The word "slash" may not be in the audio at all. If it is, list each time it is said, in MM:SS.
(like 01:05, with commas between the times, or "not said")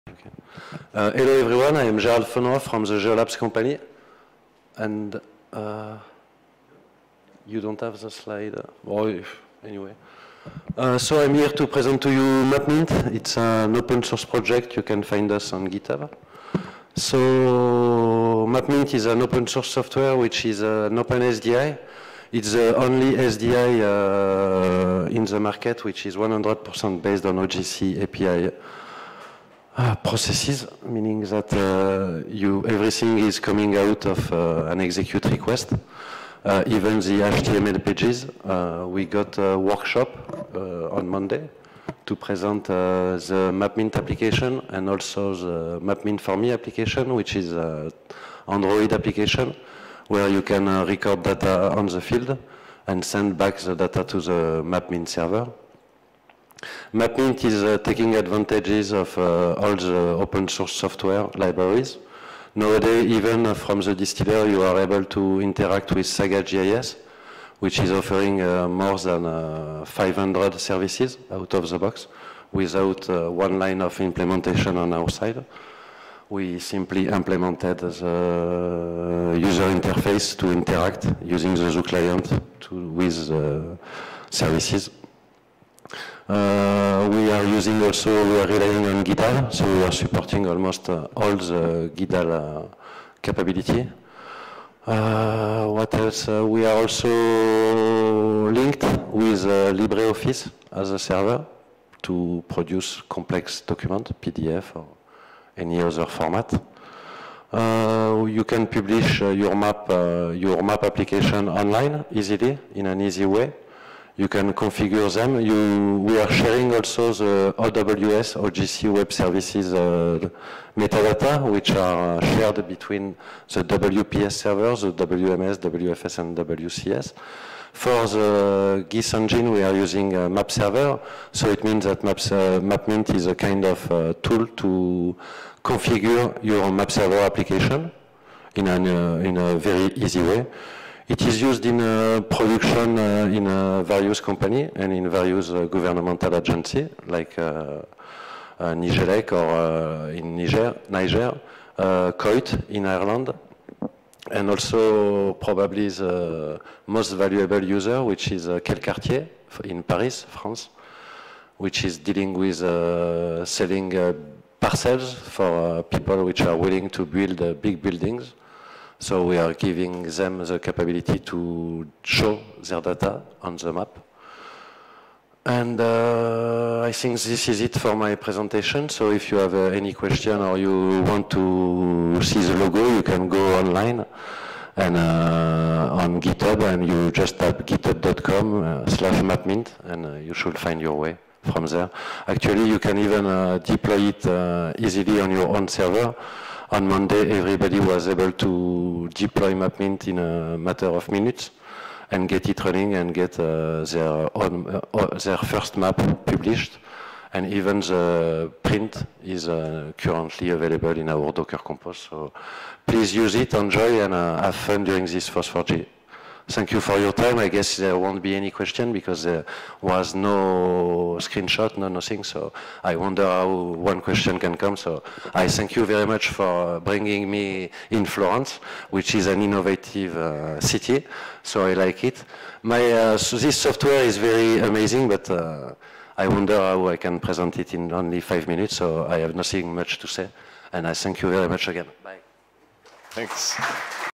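03:08.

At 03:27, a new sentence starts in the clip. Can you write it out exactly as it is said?
And even the print is uh, currently available in our Docker Compose.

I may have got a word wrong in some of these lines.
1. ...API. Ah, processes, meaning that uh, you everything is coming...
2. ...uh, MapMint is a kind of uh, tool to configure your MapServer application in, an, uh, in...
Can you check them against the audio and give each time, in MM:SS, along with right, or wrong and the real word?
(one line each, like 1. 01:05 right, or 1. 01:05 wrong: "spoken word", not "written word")
1. 00:28 right
2. 02:12 right.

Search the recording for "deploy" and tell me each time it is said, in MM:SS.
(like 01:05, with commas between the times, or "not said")
03:13, 03:19.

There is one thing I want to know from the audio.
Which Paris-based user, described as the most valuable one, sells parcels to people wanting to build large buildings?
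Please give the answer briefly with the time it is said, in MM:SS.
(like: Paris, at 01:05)
Cartier, at 02:38.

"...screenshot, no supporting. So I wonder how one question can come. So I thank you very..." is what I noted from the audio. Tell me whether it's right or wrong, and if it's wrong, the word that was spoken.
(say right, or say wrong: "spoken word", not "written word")
wrong: "nothing", not "supporting".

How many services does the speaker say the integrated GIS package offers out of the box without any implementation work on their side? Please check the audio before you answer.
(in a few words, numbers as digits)
More than 500.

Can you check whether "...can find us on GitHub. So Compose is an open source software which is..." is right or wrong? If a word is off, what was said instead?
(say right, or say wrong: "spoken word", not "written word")
wrong: "MapMint", not "Compose".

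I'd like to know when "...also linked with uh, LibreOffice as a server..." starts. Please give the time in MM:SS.
01:36.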